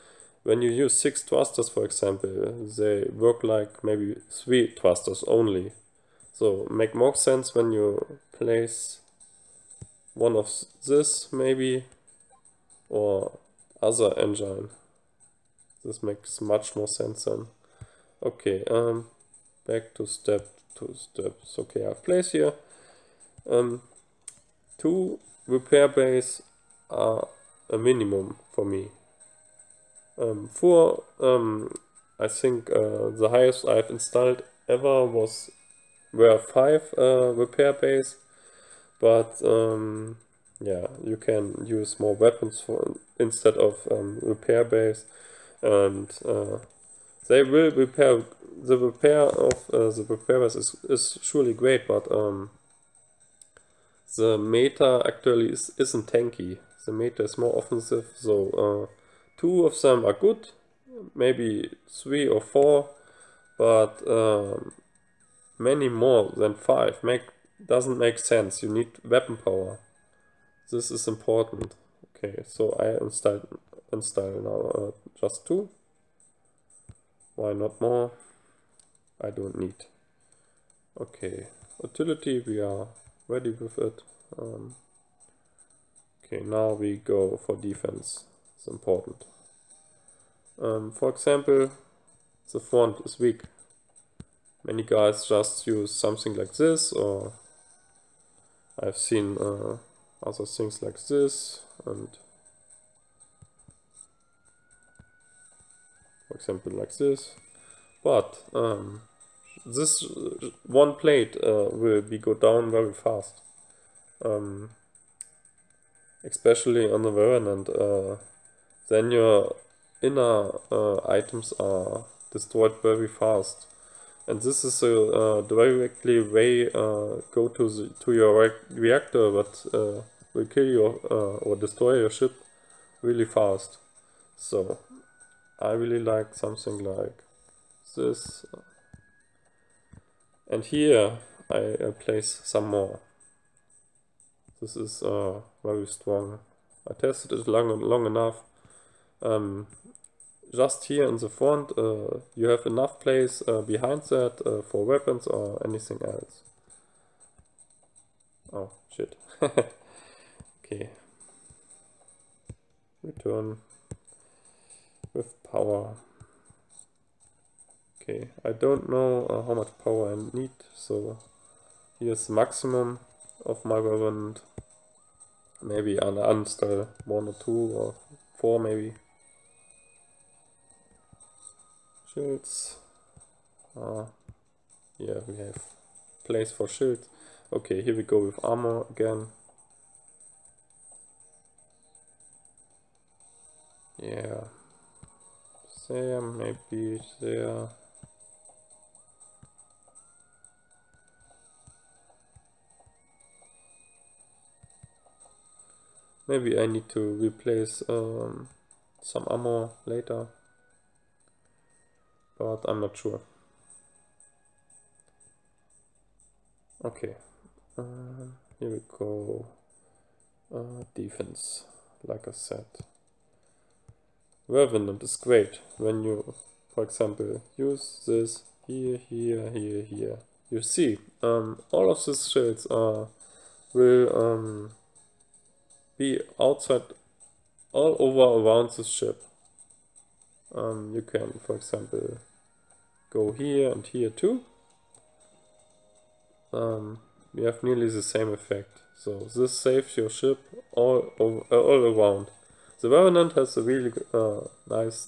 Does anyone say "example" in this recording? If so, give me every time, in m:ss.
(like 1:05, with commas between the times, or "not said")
0:01, 1:31, 1:46, 3:46, 4:01.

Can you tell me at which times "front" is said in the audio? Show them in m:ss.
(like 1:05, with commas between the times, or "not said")
1:32, 2:31.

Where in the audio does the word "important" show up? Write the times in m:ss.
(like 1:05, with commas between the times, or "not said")
1:11, 1:28.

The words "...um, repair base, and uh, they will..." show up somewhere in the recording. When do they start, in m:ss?
0:43.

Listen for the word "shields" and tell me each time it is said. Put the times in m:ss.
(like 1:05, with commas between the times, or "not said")
3:02, 3:06, 3:52.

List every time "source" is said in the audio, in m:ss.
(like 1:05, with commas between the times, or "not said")
not said.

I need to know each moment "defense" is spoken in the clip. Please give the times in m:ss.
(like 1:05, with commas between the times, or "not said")
1:27, 3:40.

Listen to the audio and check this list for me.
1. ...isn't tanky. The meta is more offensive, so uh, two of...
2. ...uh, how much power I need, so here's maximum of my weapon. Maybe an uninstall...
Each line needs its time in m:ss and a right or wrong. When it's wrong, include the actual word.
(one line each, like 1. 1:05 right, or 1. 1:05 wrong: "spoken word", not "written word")
1. 0:55 right
2. 2:49 right.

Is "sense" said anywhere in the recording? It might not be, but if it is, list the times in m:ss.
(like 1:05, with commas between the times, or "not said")
0:07, 0:16, 1:08.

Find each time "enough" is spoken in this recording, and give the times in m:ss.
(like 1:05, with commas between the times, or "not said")
2:28, 2:32.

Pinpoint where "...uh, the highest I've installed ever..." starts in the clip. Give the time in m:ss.
0:32.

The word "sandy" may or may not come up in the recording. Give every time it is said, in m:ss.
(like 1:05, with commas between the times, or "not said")
not said.